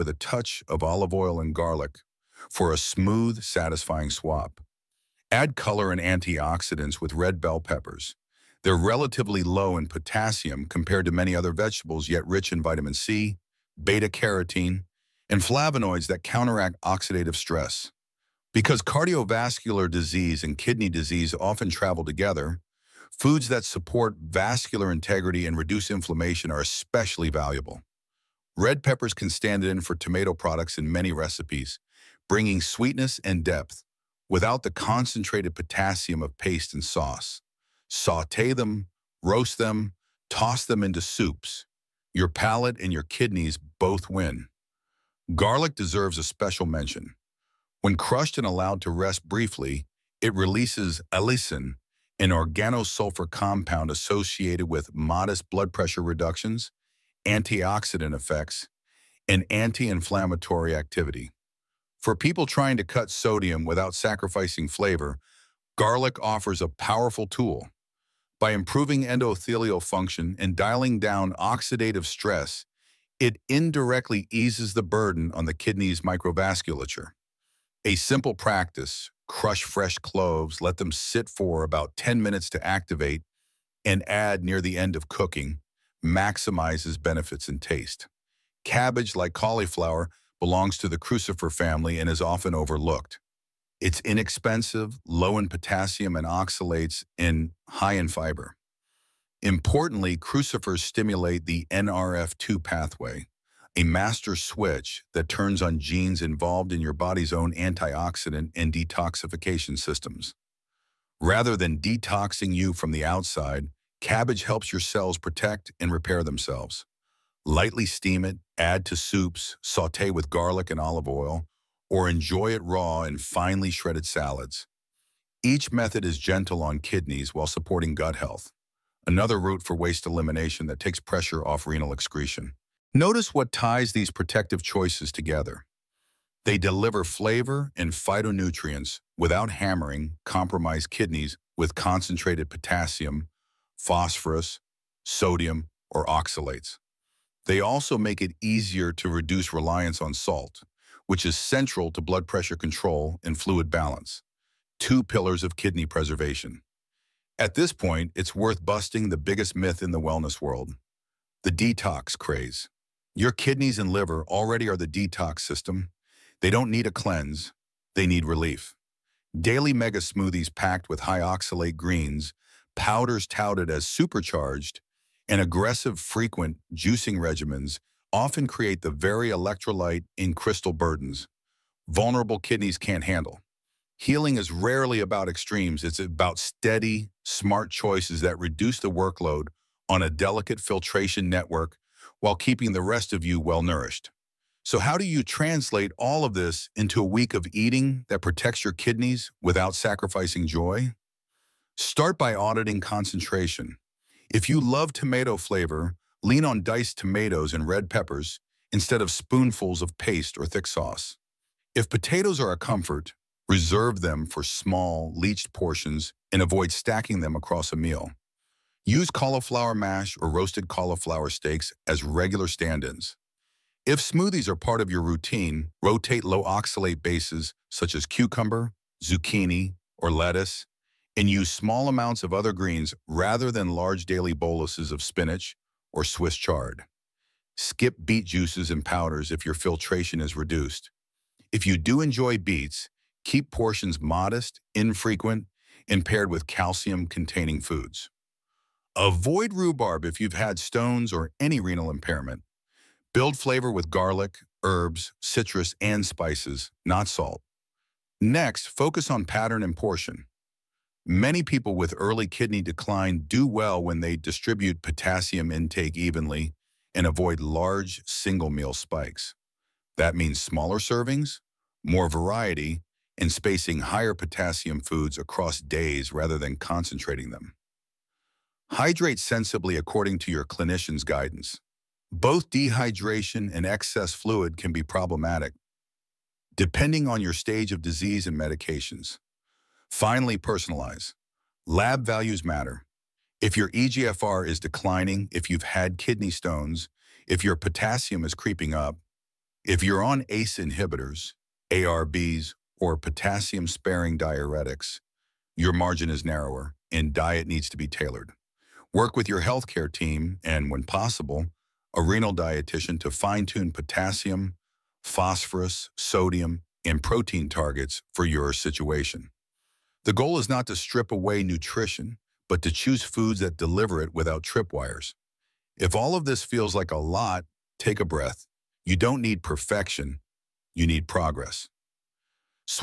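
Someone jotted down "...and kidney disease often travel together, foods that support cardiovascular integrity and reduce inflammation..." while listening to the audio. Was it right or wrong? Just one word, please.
wrong.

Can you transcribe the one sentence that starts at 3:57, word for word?
Skip beet juices and powders if your filtration is reduced.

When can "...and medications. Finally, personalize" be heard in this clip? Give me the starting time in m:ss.
4:48.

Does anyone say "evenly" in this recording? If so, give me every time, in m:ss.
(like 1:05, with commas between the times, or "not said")
4:25.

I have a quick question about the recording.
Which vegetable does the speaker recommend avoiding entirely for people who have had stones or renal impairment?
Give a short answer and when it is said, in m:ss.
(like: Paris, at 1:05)
rhubarb, at 4:09.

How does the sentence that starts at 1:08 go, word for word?
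By improving endothelial function and dialing down oxidative stress, it indirectly eases the burden on the kidney's microvasculature.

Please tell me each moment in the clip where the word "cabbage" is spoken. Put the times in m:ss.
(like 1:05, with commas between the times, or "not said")
1:28, 1:53.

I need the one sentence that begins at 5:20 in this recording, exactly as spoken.
The goal is not to strip away nutrition, but to choose foods that deliver it without tripwires.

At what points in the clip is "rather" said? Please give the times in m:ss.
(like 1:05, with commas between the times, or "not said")
1:51, 3:53, 4:36.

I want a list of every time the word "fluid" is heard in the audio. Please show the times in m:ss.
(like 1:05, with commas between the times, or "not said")
2:33, 4:44.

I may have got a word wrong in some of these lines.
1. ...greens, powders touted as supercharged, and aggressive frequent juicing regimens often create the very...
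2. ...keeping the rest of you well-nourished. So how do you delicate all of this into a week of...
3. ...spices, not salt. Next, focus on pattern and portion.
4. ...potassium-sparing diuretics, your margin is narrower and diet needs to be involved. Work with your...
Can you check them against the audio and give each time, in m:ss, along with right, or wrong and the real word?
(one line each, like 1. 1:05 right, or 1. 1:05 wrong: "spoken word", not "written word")
1. 2:51 right
2. 3:12 wrong: "translate", not "delicate"
3. 4:16 right
4. 5:02 wrong: "tailored", not "involved".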